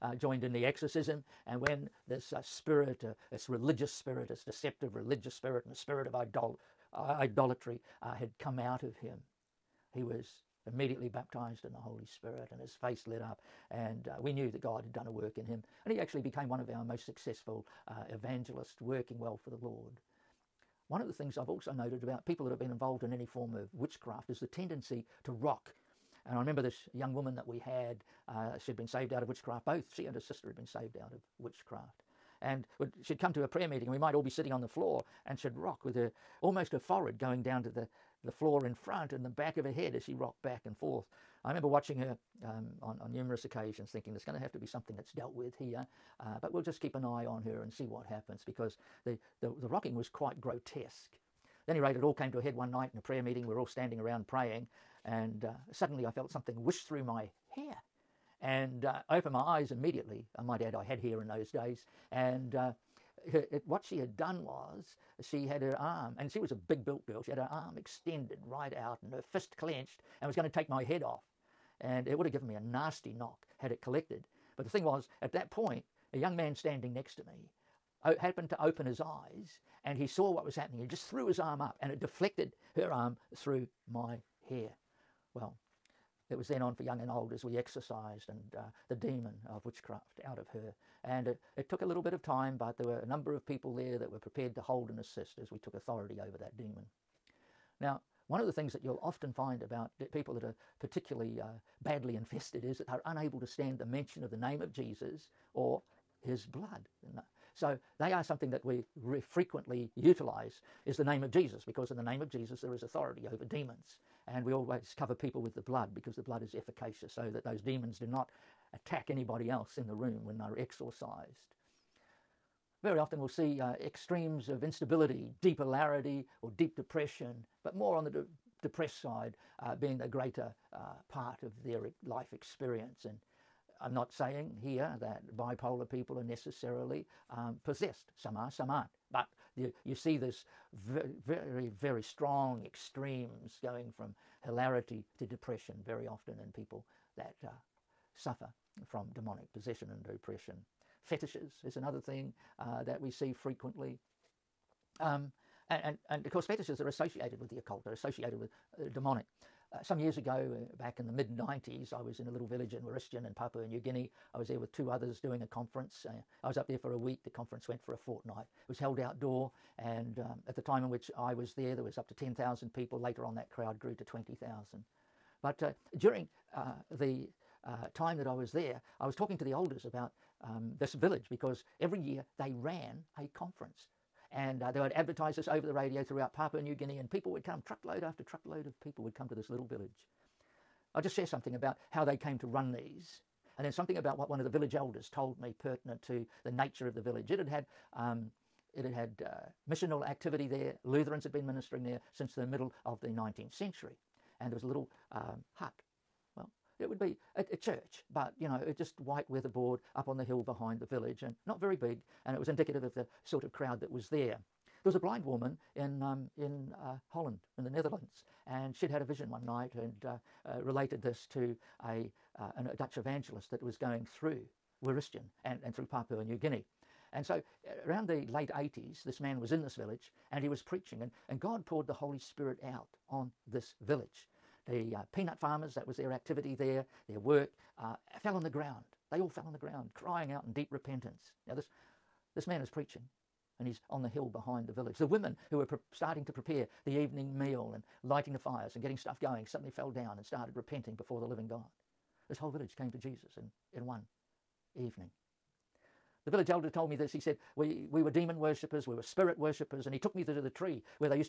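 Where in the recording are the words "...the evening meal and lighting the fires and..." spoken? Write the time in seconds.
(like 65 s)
246 s.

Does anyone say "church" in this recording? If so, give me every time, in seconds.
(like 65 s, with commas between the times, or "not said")
207 s.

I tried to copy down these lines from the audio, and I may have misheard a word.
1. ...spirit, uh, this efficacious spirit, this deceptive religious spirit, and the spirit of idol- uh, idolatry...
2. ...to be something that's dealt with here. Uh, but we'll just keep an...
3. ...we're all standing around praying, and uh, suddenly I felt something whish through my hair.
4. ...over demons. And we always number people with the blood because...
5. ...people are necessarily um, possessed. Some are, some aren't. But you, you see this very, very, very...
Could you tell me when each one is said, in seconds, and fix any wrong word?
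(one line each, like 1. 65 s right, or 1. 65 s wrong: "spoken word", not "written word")
1. 2 s wrong: "religious", not "efficacious"
2. 44 s right
3. 53 s right
4. 113 s wrong: "cover", not "number"
5. 135 s right.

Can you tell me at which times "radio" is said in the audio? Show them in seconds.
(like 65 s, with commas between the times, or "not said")
185 s.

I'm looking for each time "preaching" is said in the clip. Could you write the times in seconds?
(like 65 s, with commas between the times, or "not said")
230 s, 242 s.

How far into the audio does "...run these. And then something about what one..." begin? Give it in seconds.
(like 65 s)
192 s.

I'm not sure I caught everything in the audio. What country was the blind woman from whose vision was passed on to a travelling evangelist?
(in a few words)
The Netherlands.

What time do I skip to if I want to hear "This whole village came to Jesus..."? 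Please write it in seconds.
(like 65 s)
252 s.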